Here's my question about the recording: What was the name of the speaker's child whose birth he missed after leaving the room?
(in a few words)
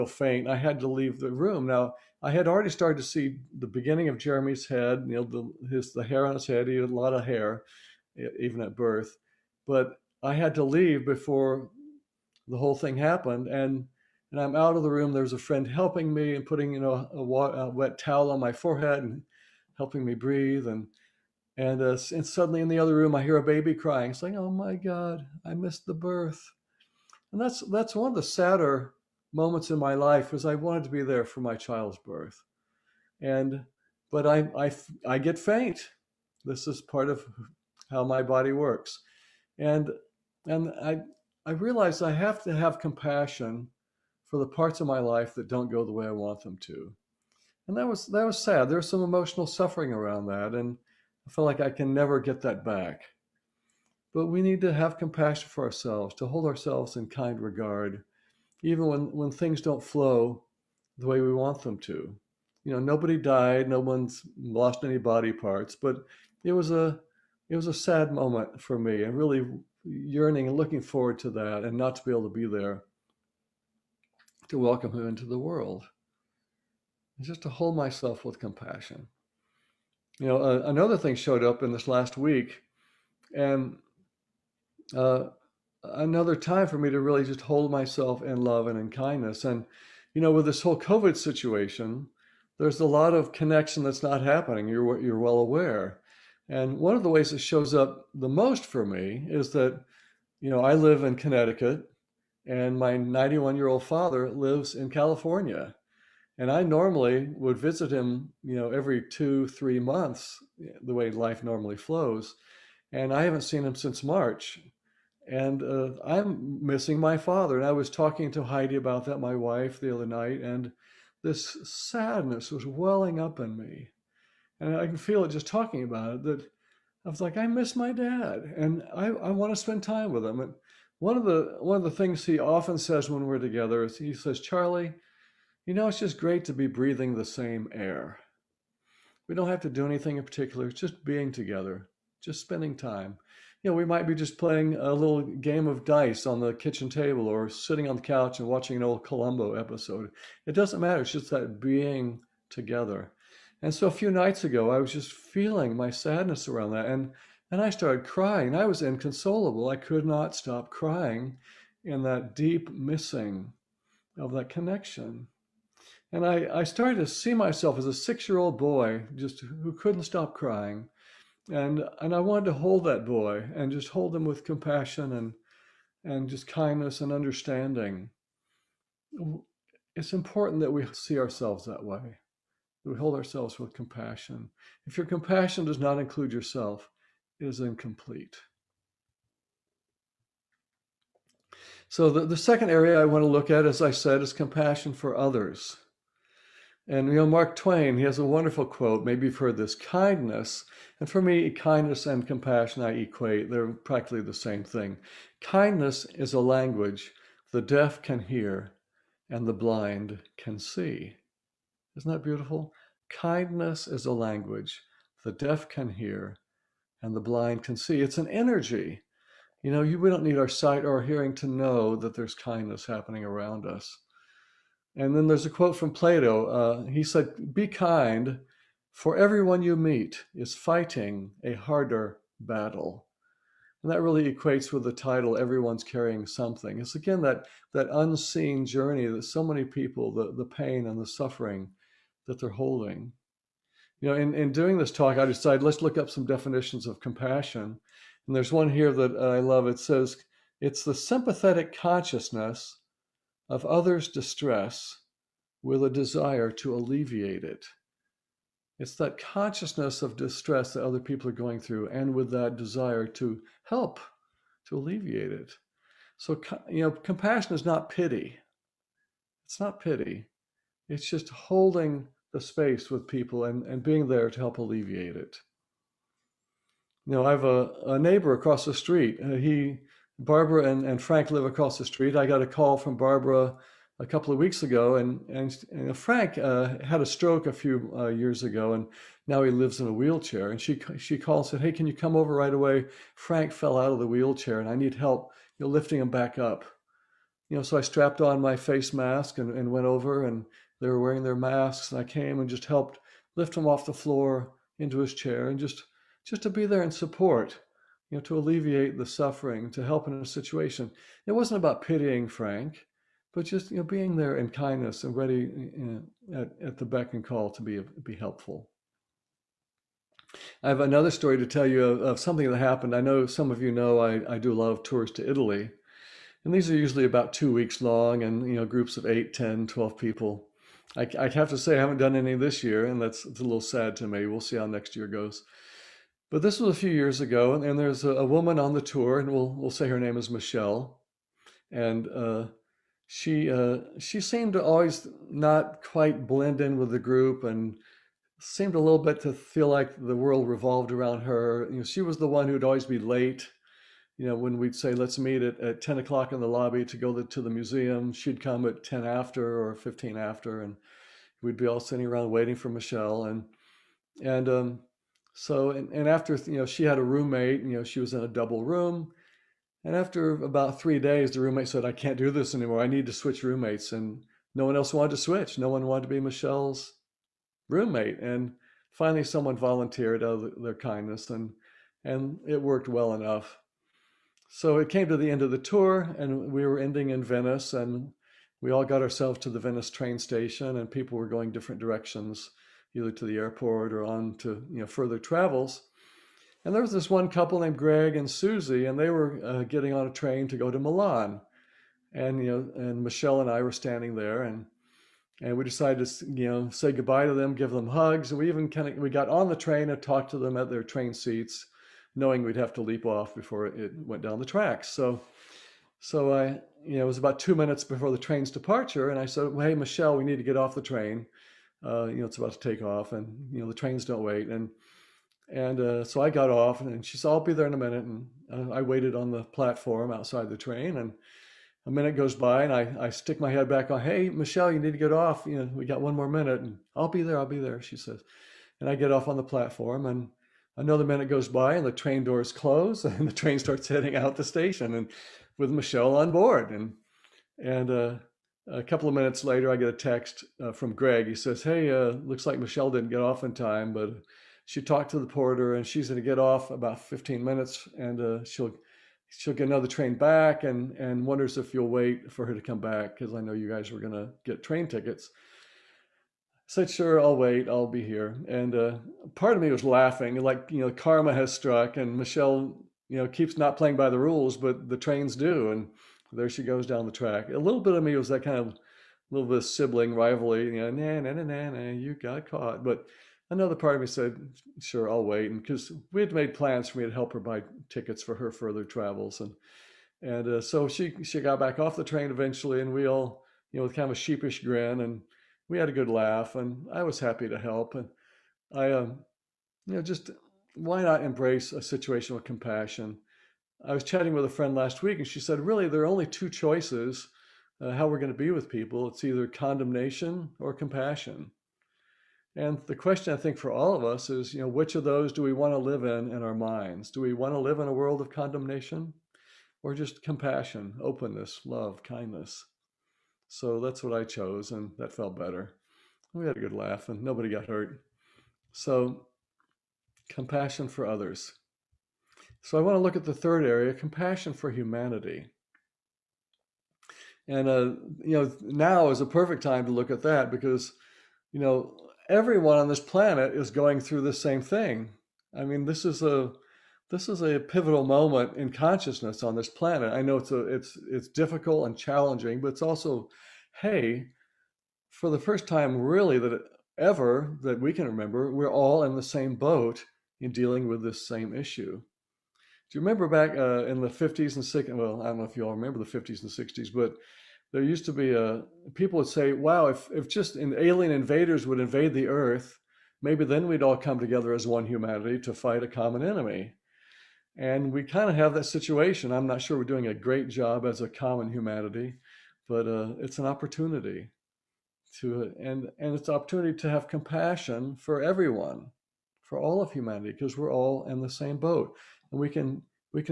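Jeremy.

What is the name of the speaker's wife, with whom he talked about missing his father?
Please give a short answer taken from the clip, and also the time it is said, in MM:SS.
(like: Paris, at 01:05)
Heidi, at 01:58.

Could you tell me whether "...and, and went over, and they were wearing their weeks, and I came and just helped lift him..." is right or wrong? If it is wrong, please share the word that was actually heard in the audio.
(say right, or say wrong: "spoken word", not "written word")
wrong: "masks", not "weeks".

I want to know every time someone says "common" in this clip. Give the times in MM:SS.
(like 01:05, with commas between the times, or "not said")
09:35, 09:41.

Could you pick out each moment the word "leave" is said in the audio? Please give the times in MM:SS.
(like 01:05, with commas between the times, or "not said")
00:00, 00:10.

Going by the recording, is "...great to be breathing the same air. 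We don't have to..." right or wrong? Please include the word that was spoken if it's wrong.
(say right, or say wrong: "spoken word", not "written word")
right.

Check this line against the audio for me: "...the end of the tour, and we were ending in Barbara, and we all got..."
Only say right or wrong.
wrong.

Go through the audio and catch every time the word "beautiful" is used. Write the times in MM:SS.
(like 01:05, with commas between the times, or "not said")
03:32.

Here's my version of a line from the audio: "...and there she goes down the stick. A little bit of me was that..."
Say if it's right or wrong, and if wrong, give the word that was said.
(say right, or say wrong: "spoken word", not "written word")
wrong: "track", not "stick".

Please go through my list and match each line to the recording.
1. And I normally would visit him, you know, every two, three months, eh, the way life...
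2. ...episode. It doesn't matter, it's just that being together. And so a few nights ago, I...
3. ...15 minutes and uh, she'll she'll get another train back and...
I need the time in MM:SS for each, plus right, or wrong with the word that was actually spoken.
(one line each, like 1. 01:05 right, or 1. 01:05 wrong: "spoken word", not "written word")
1. 01:46 right
2. 02:29 right
3. 07:37 right.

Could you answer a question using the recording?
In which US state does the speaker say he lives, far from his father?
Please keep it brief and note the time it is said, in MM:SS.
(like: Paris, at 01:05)
Connecticut, at 01:41.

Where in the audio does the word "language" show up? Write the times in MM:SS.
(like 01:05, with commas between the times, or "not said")
03:26, 03:34.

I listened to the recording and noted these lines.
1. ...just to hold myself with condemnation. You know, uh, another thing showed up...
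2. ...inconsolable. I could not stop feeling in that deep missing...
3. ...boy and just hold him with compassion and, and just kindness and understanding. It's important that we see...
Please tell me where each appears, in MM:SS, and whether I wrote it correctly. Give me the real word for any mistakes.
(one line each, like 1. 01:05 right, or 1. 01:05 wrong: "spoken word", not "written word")
1. 01:17 wrong: "compassion", not "condemnation"
2. 02:38 wrong: "crying", not "feeling"
3. 02:53 right.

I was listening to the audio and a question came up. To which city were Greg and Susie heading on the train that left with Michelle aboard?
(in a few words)
Milan.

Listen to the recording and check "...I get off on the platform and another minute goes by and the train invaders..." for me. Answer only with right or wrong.
wrong.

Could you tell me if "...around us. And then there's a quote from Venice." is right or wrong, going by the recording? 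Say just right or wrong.
wrong.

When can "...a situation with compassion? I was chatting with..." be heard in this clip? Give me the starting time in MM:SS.
08:21.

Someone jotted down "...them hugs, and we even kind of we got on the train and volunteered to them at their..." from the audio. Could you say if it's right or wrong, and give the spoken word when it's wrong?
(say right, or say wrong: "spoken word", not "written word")
wrong: "talked", not "volunteered".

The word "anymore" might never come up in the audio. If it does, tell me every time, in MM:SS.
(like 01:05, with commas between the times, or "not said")
06:12.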